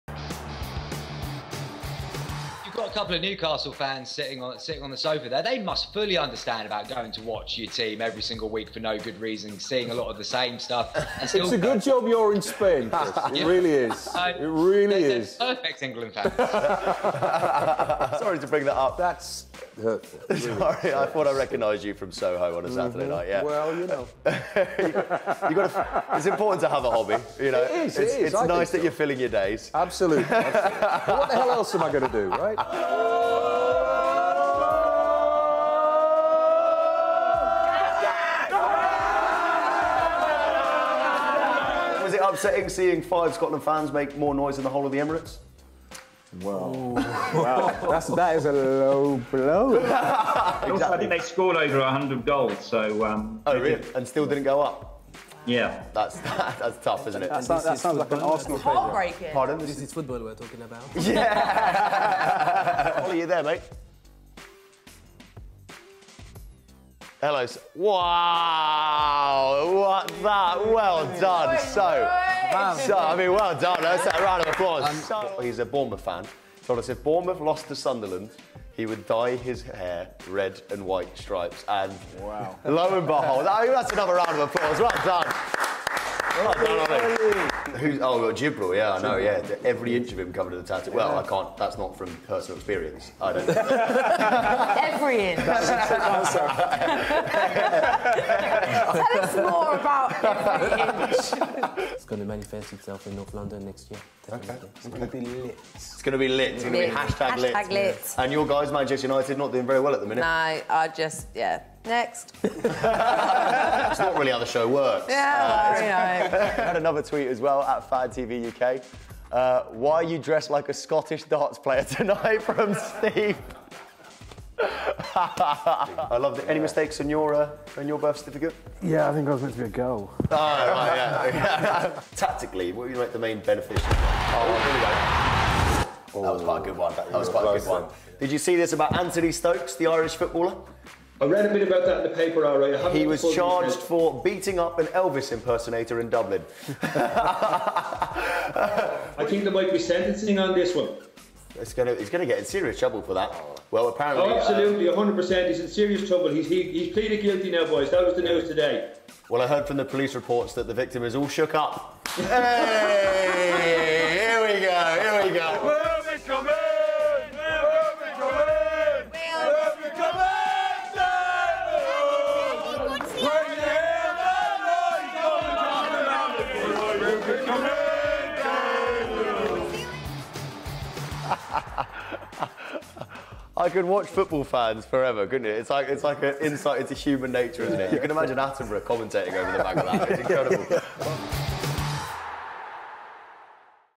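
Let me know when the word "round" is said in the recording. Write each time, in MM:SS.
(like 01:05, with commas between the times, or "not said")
01:14, 01:24.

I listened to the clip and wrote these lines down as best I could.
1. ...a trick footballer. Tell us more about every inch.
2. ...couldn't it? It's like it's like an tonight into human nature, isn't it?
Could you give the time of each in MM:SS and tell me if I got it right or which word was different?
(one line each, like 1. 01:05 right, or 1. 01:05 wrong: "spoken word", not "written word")
1. 01:35 wrong: "answer", not "footballer"
2. 03:05 wrong: "insight", not "tonight".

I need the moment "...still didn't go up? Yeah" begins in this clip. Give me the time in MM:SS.
00:54.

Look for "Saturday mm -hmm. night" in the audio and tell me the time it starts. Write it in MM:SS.
00:22.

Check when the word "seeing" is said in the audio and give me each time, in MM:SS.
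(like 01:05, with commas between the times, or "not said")
00:09, 00:42.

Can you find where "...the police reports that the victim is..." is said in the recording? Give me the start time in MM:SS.
02:39.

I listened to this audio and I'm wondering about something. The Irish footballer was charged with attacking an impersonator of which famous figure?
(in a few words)
Elvis.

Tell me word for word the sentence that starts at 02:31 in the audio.
It's gonna, he's gonna get in serious trouble for that.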